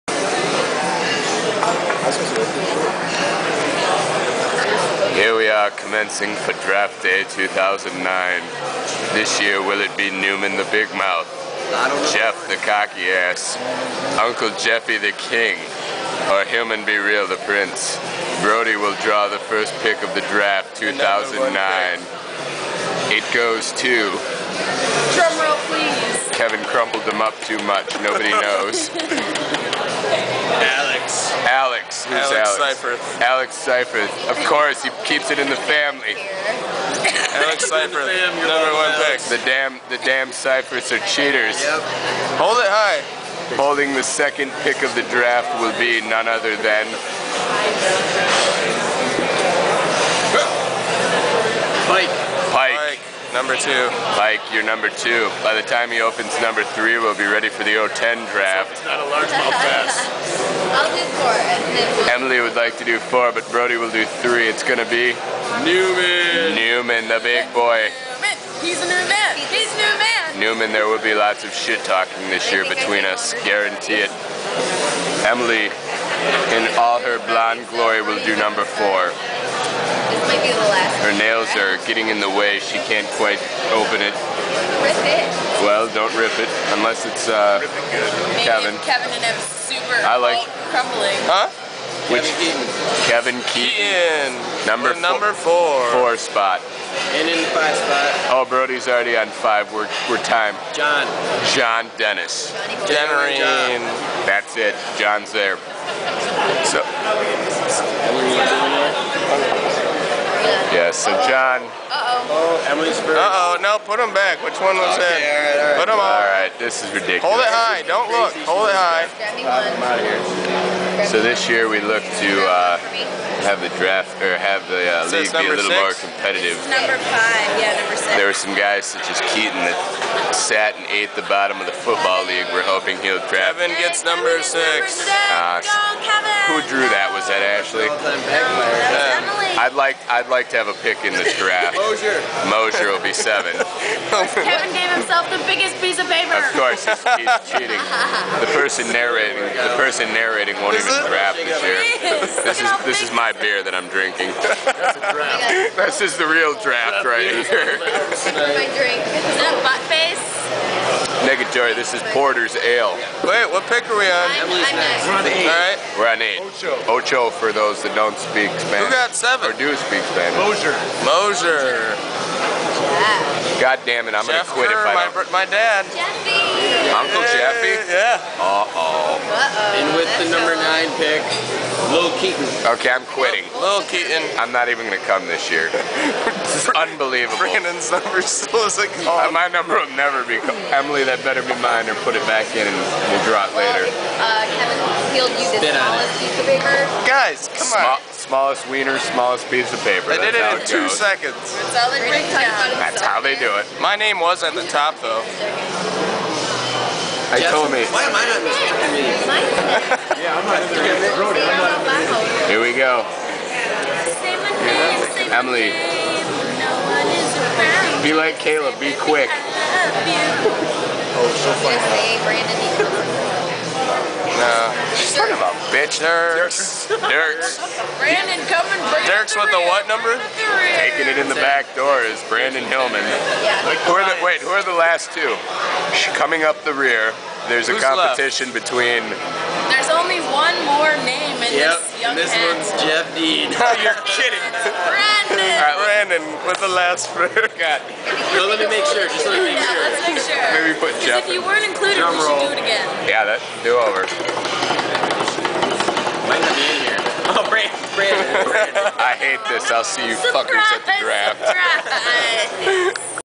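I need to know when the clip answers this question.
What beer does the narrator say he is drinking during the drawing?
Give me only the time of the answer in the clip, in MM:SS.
02:42.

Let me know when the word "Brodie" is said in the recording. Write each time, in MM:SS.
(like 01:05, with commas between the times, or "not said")
00:18, 01:03, 01:38.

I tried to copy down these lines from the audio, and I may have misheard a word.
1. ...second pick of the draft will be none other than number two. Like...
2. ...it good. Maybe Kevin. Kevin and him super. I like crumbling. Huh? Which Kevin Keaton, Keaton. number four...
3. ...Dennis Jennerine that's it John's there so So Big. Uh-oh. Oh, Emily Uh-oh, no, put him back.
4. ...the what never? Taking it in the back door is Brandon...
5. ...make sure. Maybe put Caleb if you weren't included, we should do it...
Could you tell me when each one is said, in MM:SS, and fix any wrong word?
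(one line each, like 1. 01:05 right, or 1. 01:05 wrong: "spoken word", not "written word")
1. 00:44 right
2. 01:27 right
3. 01:41 wrong: "John", not "Big"
4. 03:49 wrong: "number", not "never"
5. 04:10 wrong: "Jeff", not "Caleb".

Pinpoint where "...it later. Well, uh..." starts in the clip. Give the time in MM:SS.
03:13.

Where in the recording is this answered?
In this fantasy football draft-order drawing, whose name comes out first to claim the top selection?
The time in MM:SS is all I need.
00:37.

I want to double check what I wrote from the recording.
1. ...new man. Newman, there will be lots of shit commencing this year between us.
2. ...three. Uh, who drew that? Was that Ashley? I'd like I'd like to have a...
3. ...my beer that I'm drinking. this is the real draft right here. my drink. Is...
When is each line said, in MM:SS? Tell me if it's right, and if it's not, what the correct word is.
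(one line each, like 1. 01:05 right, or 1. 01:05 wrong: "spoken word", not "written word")
1. 01:09 wrong: "talking", not "commencing"
2. 02:14 wrong: "six", not "three"
3. 02:33 right.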